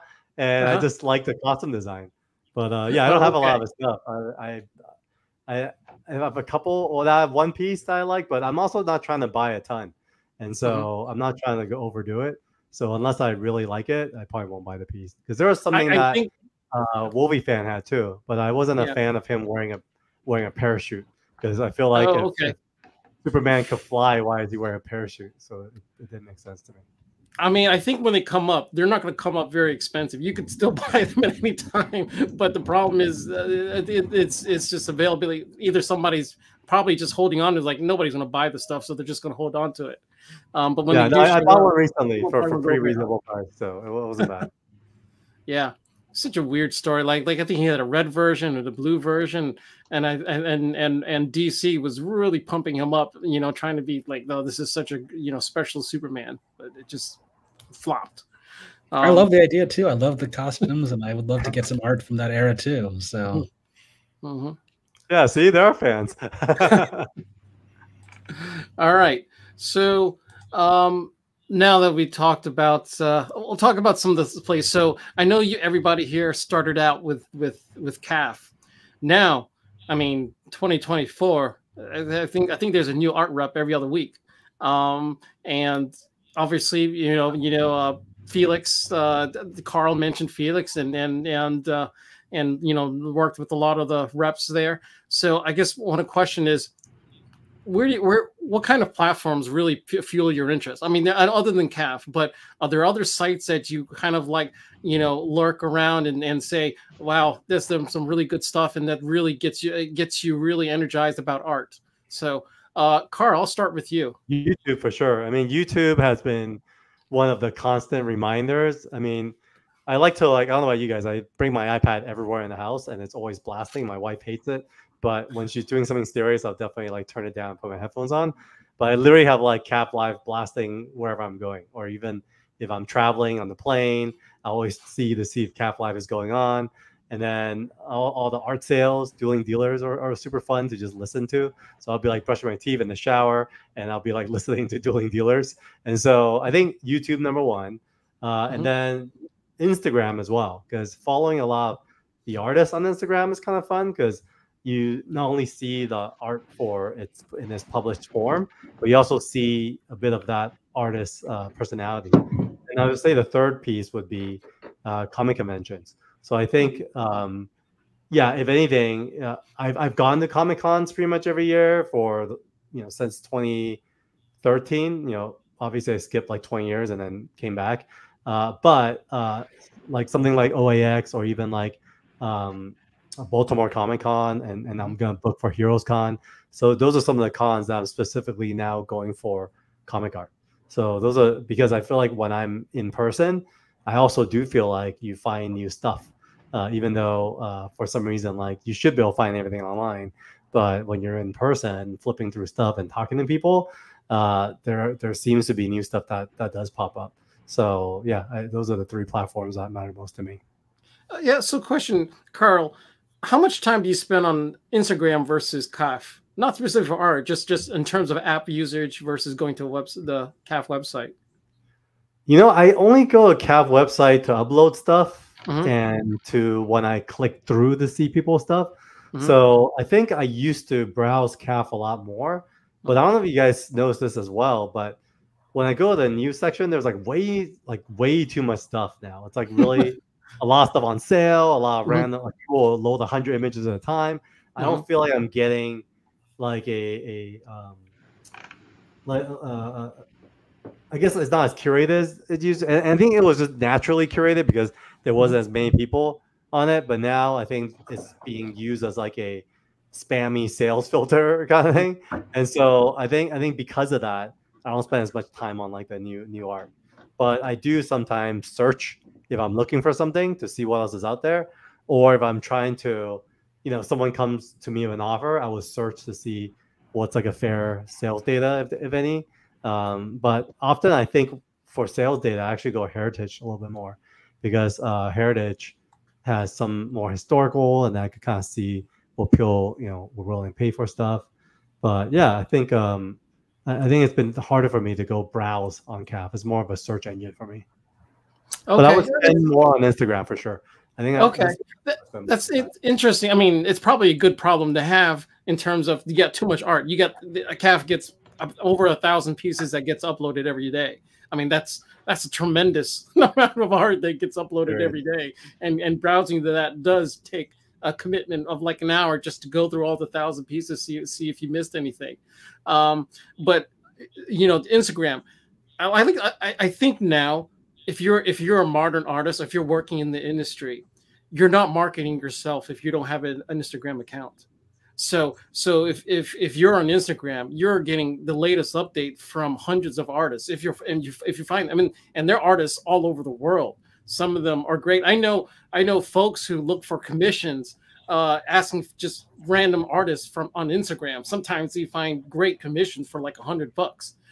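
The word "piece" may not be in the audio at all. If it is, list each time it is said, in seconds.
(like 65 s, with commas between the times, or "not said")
7 s, 14 s, 163 s, 309 s, 320 s.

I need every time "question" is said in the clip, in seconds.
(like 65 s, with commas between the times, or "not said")
96 s, 211 s.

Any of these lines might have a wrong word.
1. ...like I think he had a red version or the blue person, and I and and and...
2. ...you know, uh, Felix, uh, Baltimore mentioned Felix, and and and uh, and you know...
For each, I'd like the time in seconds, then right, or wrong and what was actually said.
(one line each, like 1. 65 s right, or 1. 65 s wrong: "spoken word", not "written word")
1. 47 s wrong: "version", not "person"
2. 87 s wrong: "Carl", not "Baltimore".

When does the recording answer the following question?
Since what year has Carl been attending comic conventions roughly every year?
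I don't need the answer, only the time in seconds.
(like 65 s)
173 s.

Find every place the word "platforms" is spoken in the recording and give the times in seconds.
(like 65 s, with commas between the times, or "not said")
98 s, 209 s.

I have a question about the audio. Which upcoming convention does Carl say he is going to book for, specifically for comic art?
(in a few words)
Heroes Con.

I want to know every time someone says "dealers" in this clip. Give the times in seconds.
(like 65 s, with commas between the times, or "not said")
139 s, 145 s.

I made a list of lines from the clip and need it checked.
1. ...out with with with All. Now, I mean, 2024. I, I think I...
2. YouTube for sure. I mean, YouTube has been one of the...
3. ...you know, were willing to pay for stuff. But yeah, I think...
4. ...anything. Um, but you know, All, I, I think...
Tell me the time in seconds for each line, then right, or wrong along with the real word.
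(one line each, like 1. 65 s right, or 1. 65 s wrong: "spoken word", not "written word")
1. 76 s wrong: "CAF", not "All"
2. 114 s right
3. 289 s right
4. 321 s wrong: "Instagram", not "All".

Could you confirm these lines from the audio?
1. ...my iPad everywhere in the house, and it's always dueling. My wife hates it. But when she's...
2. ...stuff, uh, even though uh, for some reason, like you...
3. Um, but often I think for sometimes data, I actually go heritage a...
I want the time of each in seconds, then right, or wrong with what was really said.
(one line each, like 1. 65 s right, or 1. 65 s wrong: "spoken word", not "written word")
1. 121 s wrong: "blasting", not "dueling"
2. 195 s right
3. 279 s wrong: "sales", not "sometimes".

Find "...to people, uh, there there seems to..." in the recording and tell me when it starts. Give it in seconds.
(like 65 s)
203 s.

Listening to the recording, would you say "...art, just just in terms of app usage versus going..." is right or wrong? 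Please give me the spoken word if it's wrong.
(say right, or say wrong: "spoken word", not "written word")
right.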